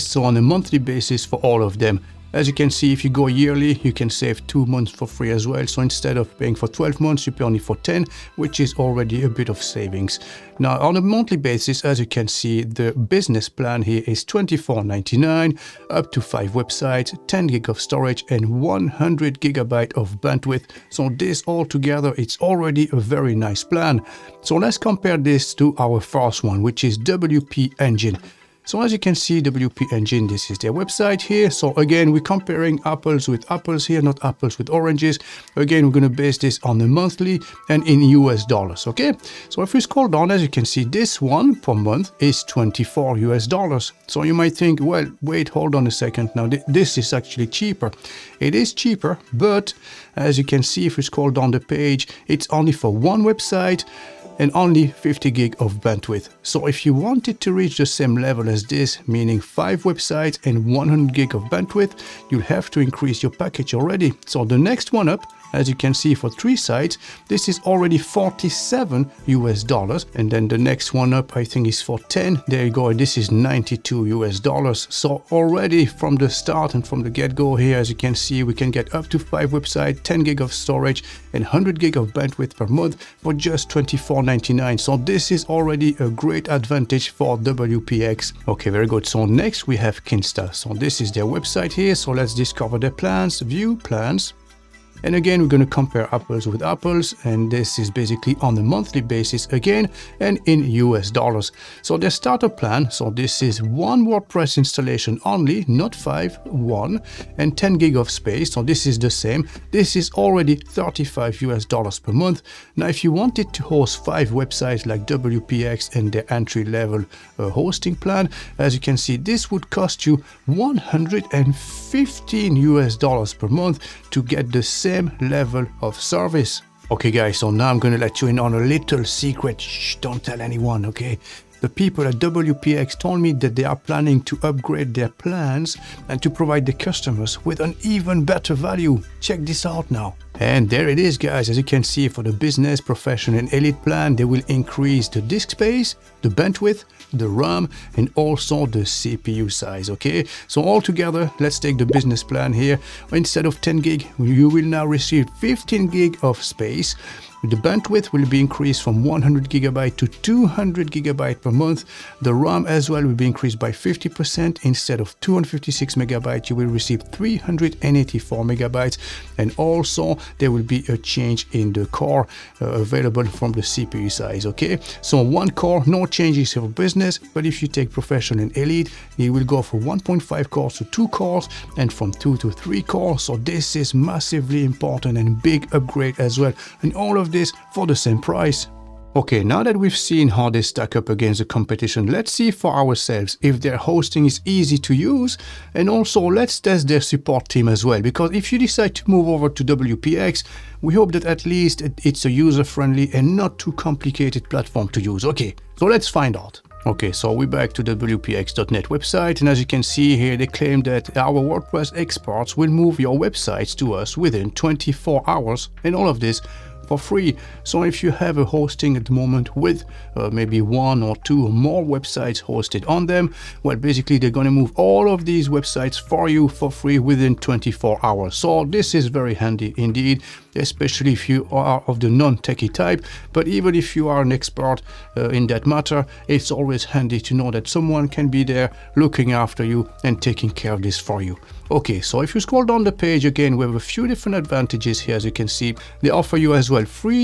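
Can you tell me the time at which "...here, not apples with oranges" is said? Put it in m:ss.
0:33.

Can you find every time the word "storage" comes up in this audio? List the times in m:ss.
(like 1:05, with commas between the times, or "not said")
0:17, 1:20.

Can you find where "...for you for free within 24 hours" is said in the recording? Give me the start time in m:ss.
3:45.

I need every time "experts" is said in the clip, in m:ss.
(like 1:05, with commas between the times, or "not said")
3:31, 3:54.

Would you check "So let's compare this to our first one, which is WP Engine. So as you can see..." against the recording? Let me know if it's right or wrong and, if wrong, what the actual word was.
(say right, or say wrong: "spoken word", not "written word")
right.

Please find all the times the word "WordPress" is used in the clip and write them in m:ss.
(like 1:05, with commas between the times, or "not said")
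1:44, 3:31.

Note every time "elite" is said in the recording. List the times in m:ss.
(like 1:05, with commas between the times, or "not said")
2:23, 2:58.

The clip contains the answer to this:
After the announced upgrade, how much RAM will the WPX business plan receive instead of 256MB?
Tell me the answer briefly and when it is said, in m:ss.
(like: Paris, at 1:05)
384MB, at 2:47.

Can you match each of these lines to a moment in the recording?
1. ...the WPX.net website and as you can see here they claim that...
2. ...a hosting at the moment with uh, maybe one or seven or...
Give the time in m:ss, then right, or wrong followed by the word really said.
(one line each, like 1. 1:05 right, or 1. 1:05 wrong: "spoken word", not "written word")
1. 3:27 right
2. 3:38 wrong: "two", not "seven".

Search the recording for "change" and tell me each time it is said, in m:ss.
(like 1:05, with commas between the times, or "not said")
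2:50, 2:56.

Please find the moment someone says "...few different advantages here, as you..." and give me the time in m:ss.
4:03.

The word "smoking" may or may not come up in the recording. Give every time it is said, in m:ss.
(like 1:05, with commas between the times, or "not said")
not said.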